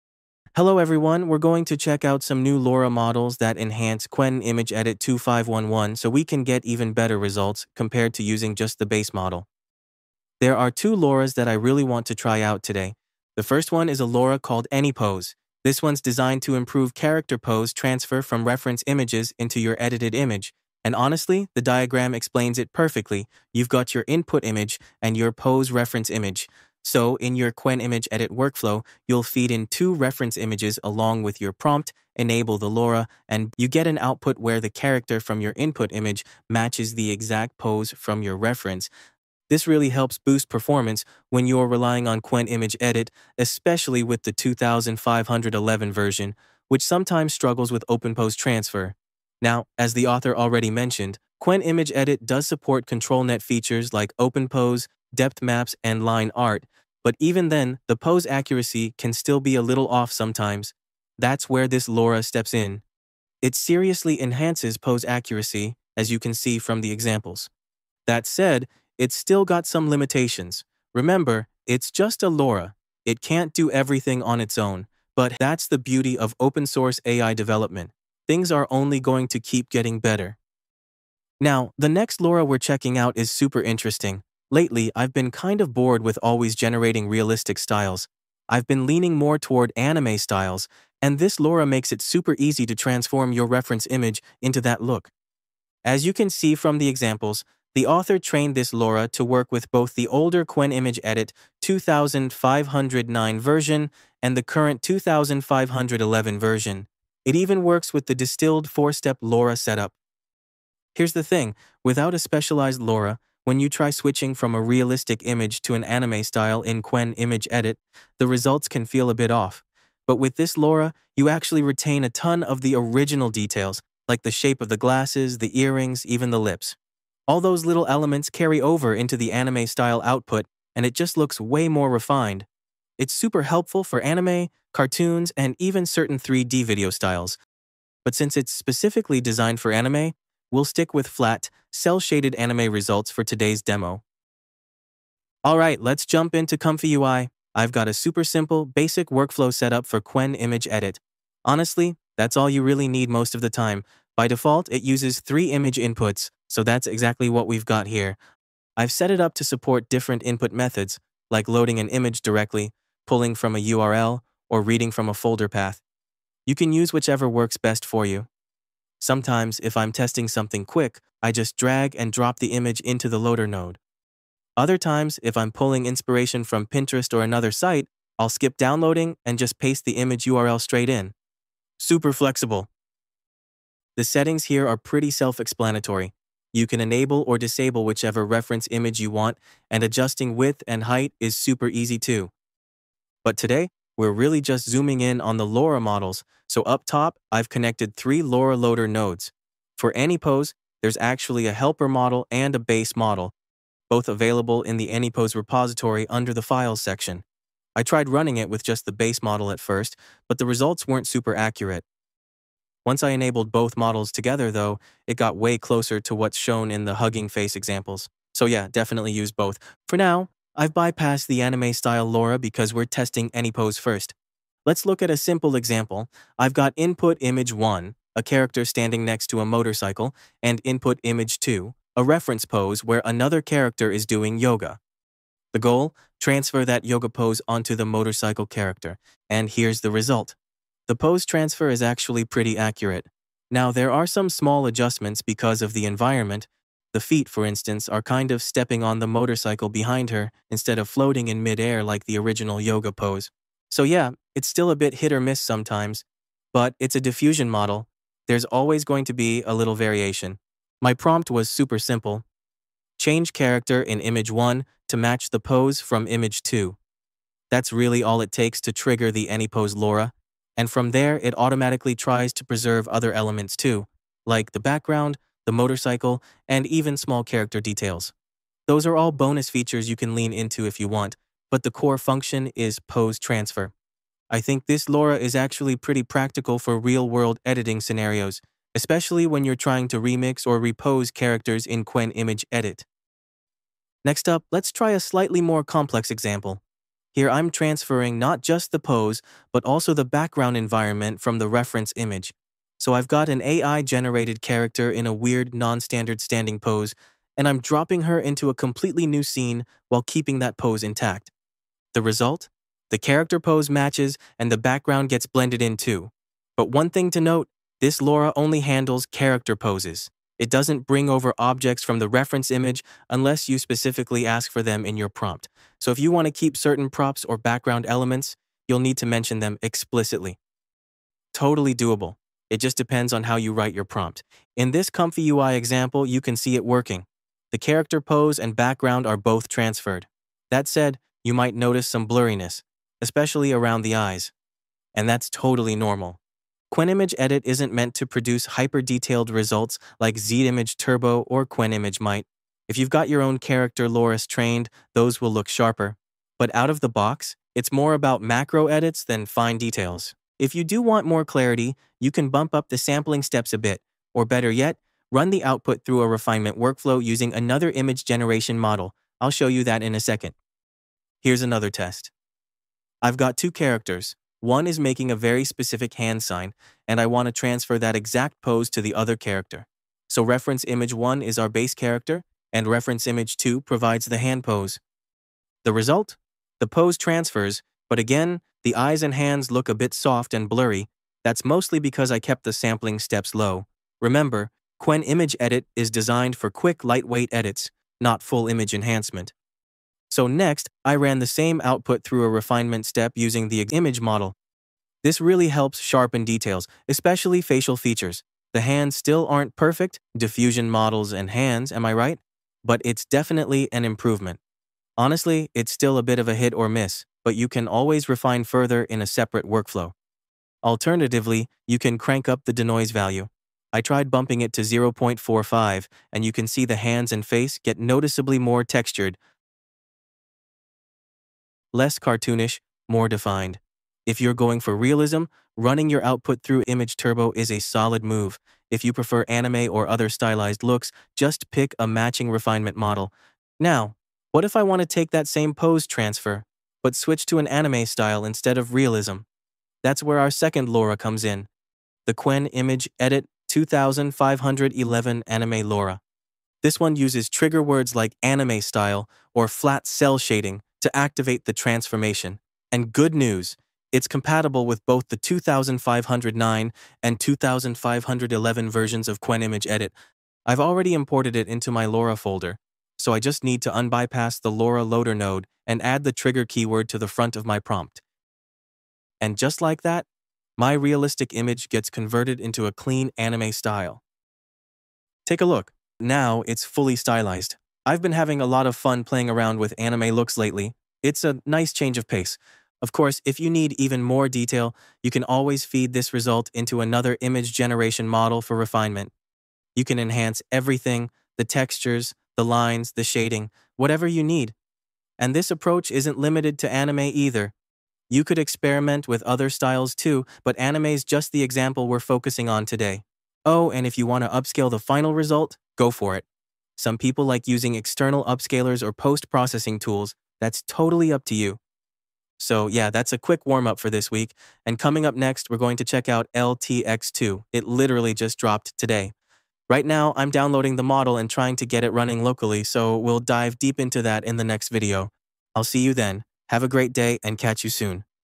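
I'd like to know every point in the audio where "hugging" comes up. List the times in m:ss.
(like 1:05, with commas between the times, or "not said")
3:36.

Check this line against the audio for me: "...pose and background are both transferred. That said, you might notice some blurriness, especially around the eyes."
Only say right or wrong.
right.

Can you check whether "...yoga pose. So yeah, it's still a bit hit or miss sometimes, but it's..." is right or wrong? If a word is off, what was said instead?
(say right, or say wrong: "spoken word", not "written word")
right.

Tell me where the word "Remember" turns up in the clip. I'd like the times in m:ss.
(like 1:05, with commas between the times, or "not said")
1:10, 6:34.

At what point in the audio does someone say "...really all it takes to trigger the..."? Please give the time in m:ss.
4:27.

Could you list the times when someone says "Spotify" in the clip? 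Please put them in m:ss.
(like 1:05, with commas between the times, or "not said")
not said.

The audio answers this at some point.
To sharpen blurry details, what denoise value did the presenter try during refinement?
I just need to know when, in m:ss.
7:04.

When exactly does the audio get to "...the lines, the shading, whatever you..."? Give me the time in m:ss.
8:22.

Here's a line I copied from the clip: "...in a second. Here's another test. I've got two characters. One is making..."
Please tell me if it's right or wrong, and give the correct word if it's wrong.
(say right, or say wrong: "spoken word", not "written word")
right.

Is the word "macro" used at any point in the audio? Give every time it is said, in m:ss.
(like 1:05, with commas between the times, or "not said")
5:58.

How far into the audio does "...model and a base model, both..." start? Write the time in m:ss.
3:21.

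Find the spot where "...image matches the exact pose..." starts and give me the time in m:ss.
0:35.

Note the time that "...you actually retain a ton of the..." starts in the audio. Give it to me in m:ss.
2:01.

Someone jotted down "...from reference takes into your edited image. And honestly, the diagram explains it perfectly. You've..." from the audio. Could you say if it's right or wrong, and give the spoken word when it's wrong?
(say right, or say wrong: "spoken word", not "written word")
wrong: "images", not "takes".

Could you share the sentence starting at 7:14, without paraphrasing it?
If you're going for realism, running your output through Image Turbo is a solid move.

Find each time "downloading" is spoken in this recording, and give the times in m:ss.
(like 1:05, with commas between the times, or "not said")
2:58, 8:50.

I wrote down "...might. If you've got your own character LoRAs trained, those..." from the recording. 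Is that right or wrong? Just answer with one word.
right.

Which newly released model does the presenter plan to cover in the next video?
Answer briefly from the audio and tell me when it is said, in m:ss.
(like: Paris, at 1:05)
LTX2, at 8:46.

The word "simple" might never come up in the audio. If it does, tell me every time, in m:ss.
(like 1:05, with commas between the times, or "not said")
2:28, 3:45, 4:21.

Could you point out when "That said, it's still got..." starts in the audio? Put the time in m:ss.
1:08.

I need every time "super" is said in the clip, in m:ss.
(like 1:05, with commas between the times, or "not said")
1:23, 1:32, 2:13, 2:27, 3:01, 3:11, 3:31, 4:21.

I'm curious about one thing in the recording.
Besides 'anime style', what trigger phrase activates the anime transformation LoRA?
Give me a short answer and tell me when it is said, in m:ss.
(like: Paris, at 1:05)
flat cel shading, at 7:39.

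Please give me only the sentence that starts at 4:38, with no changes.
Those are all bonus features you can lean into if you want, but the core function is pose transfer.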